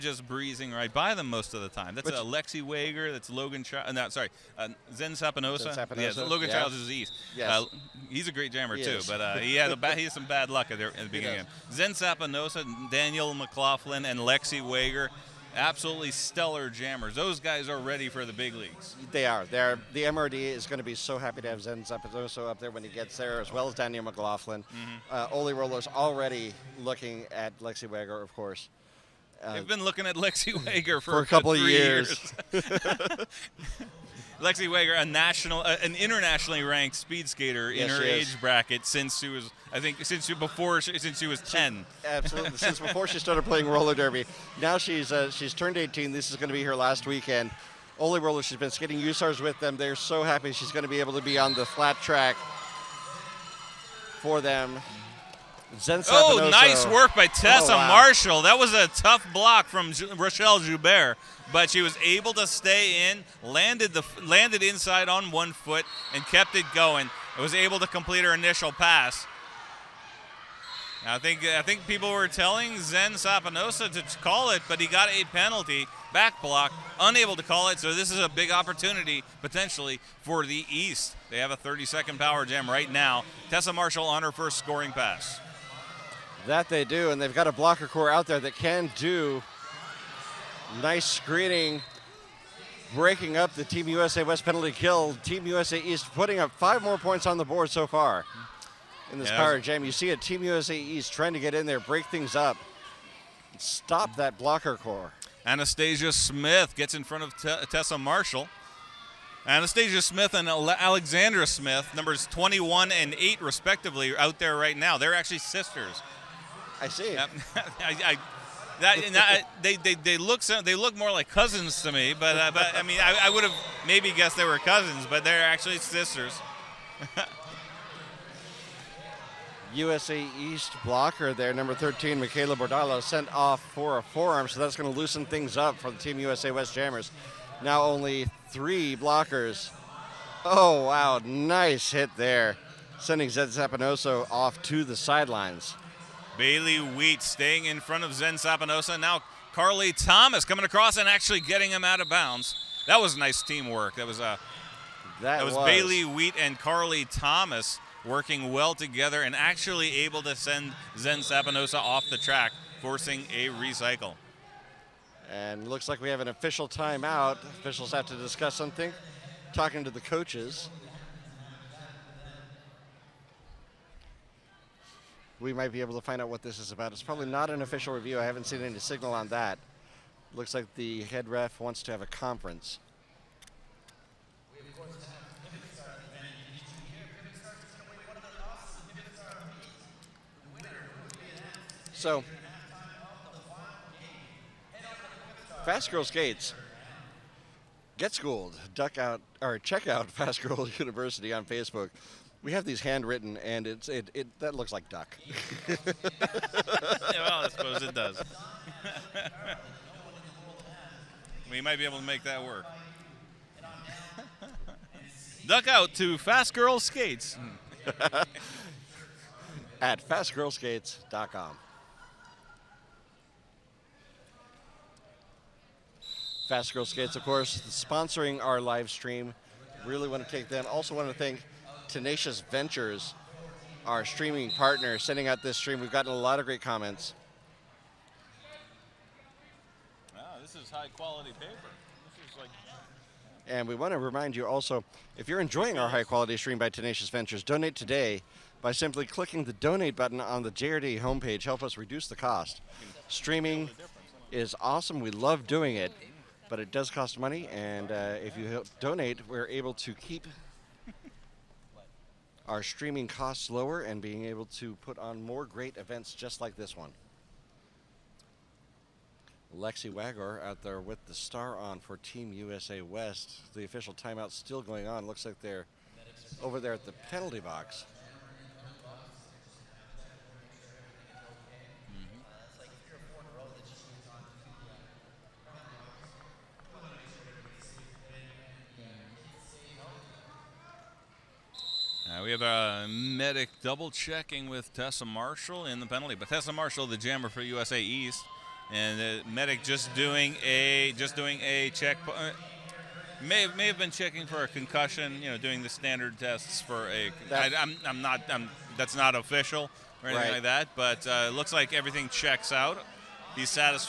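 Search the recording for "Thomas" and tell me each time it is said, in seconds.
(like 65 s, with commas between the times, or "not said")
149 s, 157 s.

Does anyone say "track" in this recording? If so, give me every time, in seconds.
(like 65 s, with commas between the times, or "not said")
52 s, 162 s.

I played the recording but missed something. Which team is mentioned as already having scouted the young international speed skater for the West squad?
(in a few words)
Oly Rollers.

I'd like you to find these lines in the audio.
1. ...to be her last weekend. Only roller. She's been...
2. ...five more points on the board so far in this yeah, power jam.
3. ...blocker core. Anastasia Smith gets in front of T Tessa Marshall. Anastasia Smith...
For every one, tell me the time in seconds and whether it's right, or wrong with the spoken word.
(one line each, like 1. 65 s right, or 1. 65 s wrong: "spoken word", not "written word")
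1. 46 s right
2. 96 s right
3. 104 s right.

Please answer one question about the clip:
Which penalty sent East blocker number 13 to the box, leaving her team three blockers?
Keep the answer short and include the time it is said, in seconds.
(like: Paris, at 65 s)
forearm, at 134 s.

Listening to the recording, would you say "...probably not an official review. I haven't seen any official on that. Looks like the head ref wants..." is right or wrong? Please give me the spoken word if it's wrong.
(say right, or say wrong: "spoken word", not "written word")
wrong: "signal", not "official".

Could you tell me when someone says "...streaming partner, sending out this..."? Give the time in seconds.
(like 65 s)
234 s.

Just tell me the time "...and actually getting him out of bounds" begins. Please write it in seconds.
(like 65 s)
150 s.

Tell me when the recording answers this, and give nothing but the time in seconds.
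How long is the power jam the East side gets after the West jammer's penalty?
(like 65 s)
81 s.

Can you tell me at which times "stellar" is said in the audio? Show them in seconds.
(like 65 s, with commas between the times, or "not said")
16 s.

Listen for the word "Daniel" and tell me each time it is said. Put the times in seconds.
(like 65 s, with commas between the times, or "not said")
12 s, 23 s.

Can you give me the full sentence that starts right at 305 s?
You know, doing the standard tests for a.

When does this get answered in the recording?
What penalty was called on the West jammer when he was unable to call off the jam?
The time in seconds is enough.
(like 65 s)
76 s.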